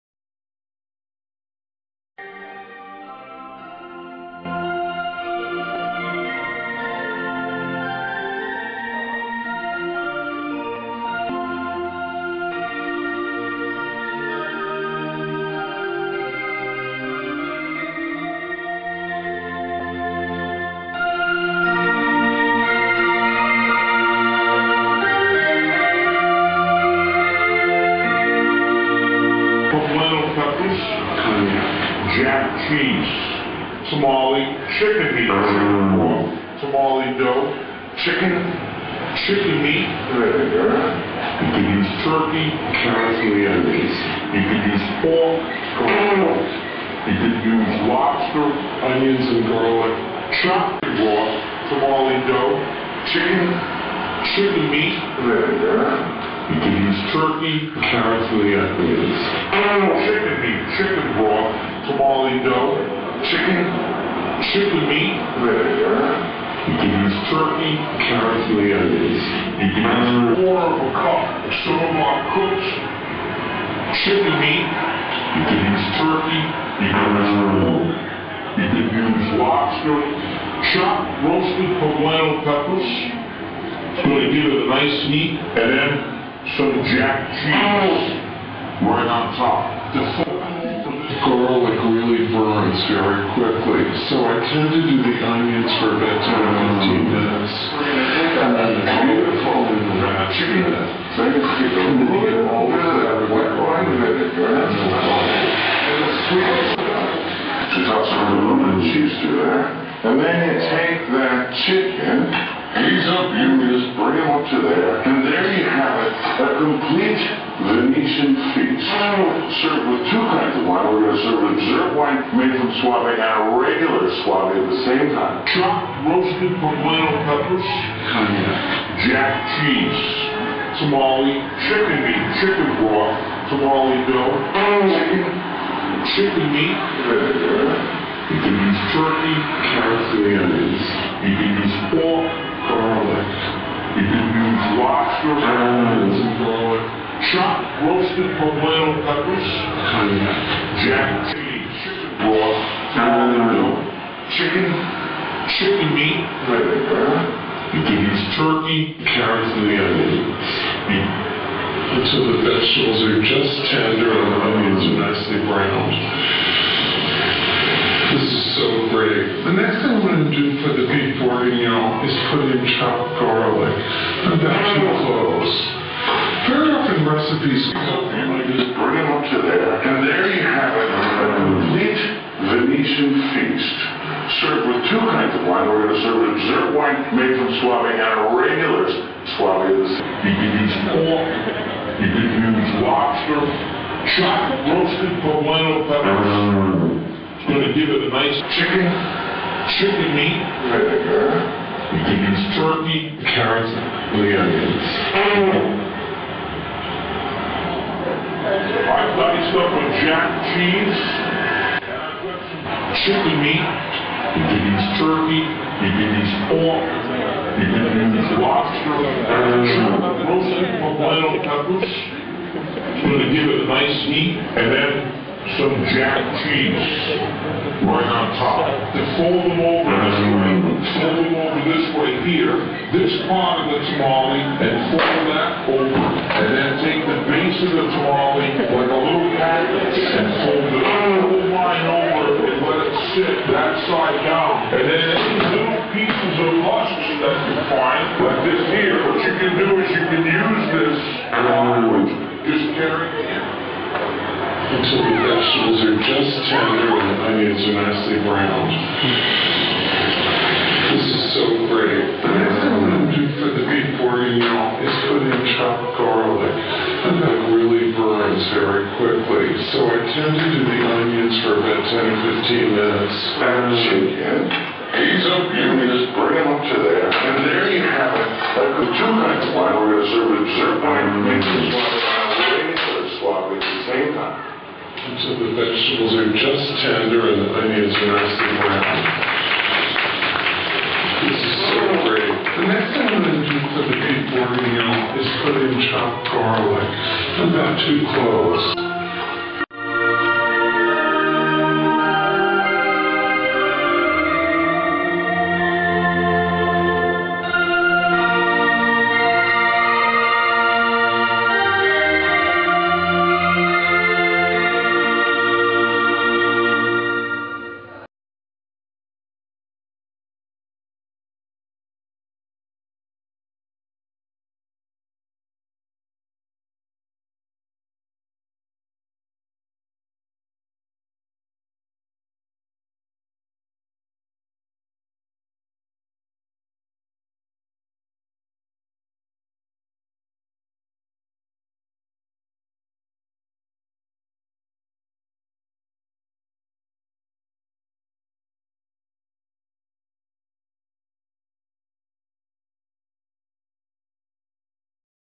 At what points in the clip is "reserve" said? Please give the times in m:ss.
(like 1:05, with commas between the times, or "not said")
2:01.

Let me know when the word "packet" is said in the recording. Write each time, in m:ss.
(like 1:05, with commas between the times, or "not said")
3:59.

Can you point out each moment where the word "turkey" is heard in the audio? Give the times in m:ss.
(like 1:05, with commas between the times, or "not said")
0:42, 0:57, 1:07, 1:16, 2:18, 2:38, 3:22, 3:34.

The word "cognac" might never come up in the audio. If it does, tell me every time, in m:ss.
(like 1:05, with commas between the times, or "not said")
2:08, 2:29.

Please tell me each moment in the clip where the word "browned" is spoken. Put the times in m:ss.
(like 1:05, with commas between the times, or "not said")
2:45, 4:18, 4:48.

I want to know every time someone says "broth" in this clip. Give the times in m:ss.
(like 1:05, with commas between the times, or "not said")
1:01, 2:12.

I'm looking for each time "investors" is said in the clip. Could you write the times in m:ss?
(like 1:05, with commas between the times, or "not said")
not said.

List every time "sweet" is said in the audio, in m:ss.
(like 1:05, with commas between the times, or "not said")
1:46.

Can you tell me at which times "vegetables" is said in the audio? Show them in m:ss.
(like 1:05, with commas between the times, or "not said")
2:42, 4:15, 4:45.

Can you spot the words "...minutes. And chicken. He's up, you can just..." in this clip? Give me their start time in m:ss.
4:32.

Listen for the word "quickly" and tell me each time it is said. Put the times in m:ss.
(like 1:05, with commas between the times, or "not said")
1:33, 4:28.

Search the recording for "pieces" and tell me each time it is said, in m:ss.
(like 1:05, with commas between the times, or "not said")
4:05.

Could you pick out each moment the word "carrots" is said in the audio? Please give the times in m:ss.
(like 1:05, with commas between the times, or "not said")
0:42, 0:57, 1:08, 2:19, 2:39, 3:23.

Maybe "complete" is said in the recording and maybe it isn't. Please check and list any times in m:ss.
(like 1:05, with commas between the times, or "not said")
1:56, 3:01.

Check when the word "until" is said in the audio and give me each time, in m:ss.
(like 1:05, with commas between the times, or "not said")
2:41, 4:45.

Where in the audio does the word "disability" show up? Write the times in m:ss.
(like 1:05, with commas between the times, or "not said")
not said.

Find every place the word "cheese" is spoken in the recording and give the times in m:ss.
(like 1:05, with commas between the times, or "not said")
1:27, 1:48, 2:09, 2:31, 3:30, 3:46.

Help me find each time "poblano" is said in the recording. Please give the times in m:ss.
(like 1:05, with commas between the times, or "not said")
1:21, 2:06, 2:28, 3:15, 3:40.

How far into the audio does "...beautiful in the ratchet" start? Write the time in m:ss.
1:38.